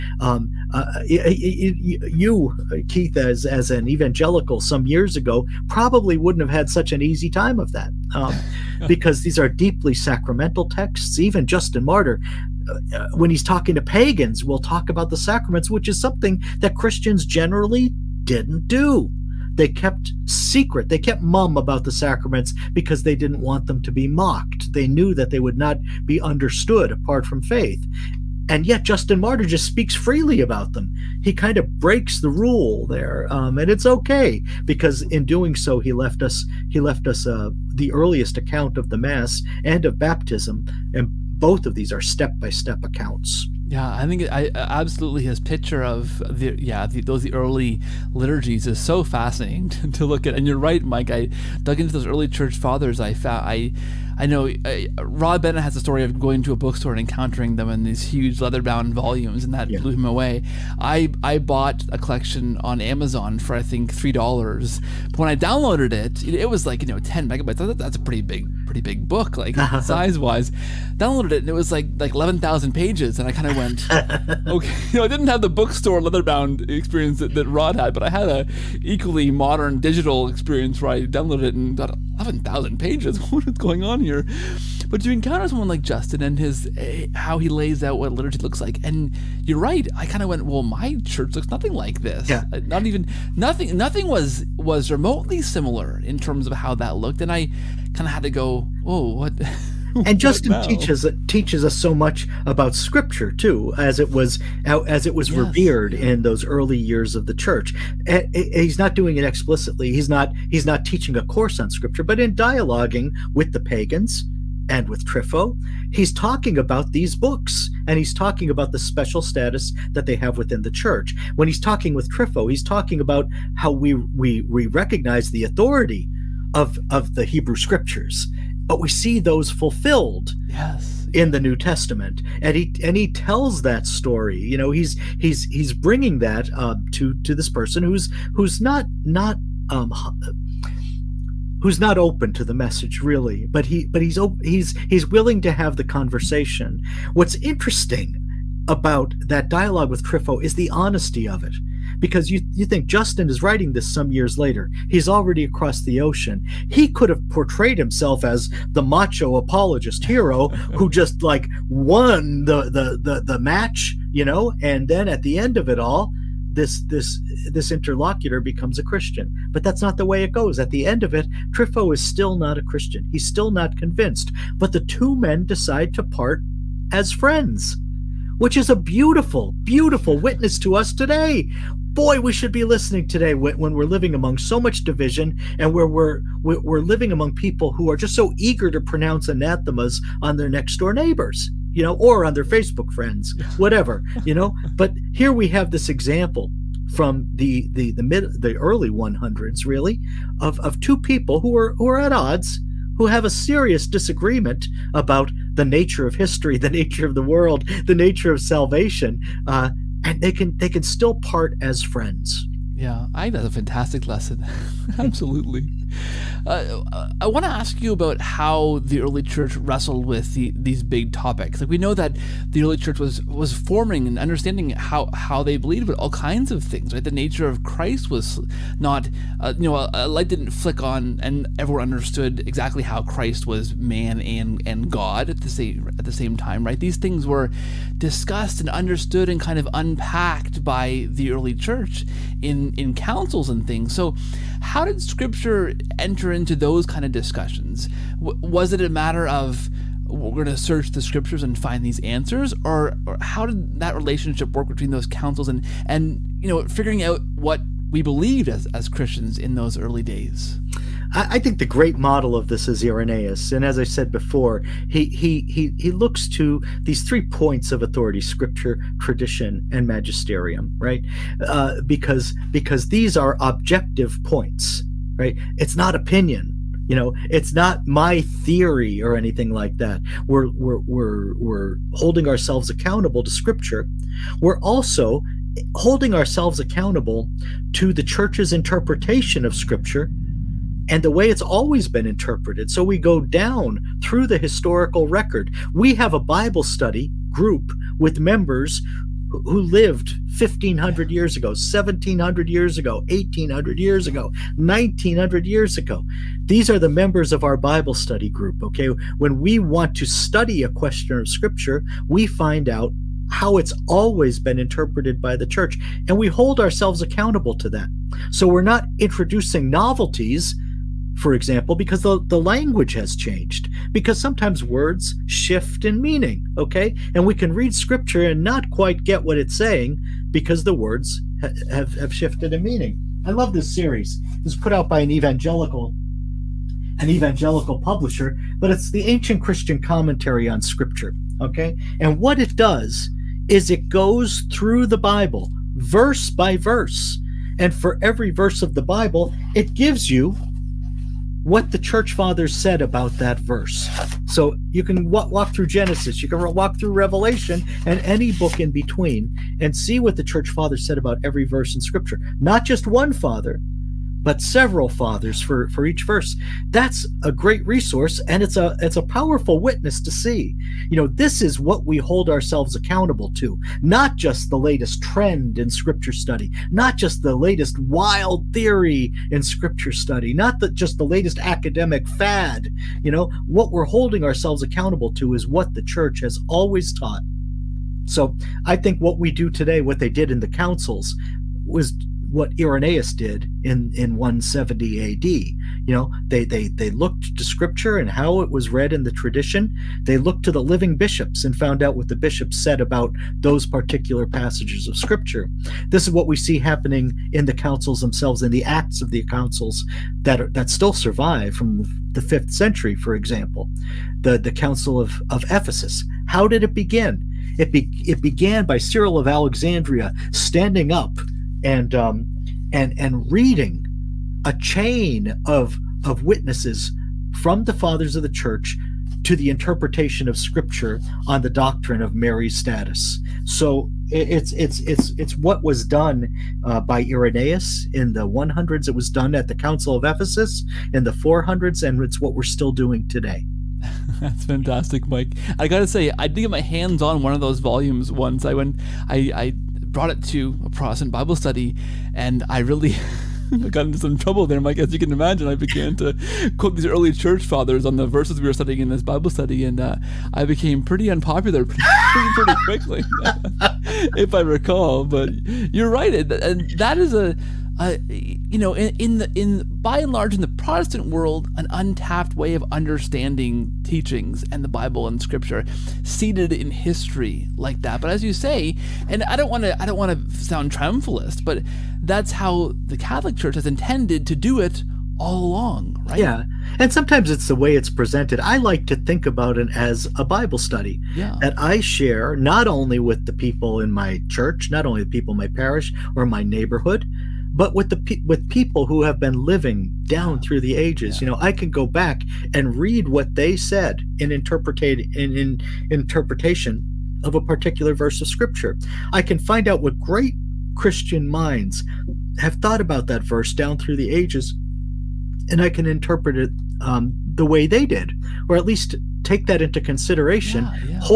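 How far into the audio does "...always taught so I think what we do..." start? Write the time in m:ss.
6:26.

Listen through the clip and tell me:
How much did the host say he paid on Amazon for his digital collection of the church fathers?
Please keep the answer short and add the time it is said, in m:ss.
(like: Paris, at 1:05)
$3, at 1:03.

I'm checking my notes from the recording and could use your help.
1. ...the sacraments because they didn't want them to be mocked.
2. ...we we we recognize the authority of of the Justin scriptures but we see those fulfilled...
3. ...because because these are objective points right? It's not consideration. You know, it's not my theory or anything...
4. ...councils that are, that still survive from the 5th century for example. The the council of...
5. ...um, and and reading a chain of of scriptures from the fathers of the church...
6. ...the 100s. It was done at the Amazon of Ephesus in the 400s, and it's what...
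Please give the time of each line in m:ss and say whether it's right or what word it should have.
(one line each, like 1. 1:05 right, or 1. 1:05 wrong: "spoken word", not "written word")
1. 0:21 right
2. 2:03 wrong: "Hebrew", not "Justin"
3. 4:31 wrong: "opinion", not "consideration"
4. 6:49 right
5. 7:01 wrong: "witnesses", not "scriptures"
6. 7:18 wrong: "Council", not "Amazon".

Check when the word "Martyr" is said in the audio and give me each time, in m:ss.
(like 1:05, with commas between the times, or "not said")
0:11, 0:29.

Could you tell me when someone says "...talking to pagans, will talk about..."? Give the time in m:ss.
0:13.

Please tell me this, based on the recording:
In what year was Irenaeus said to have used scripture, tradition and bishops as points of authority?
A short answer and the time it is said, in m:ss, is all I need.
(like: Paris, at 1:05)
170 AD, at 6:34.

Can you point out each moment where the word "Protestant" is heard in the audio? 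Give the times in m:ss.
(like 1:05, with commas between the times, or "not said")
7:30, 7:50.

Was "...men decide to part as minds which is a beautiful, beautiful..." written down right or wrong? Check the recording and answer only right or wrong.
wrong.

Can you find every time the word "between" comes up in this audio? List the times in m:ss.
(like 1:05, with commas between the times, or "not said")
4:14, 5:58.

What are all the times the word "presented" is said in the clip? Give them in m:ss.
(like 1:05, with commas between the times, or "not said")
8:07.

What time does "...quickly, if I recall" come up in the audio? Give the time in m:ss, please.
7:42.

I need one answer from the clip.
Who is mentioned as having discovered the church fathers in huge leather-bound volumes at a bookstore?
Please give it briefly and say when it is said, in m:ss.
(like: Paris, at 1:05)
Rod Bennett, at 0:55.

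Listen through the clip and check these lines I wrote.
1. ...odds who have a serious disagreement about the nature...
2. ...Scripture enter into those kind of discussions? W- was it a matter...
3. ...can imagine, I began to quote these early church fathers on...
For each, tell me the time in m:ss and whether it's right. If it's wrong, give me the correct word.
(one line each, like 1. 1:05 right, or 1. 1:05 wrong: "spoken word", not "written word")
1. 3:22 right
2. 4:05 right
3. 7:34 right.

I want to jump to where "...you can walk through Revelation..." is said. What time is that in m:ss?
5:56.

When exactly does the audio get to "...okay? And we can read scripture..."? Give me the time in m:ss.
5:26.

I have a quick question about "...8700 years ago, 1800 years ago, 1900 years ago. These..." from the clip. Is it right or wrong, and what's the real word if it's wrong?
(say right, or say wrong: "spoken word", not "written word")
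wrong: "1700", not "8700".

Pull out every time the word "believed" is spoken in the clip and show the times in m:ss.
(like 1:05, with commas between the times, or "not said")
3:45, 4:18.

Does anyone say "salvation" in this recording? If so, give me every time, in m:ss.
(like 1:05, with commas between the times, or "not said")
3:28.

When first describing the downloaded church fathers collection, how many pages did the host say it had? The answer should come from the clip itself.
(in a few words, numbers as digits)
11,000.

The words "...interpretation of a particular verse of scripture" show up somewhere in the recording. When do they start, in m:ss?
8:25.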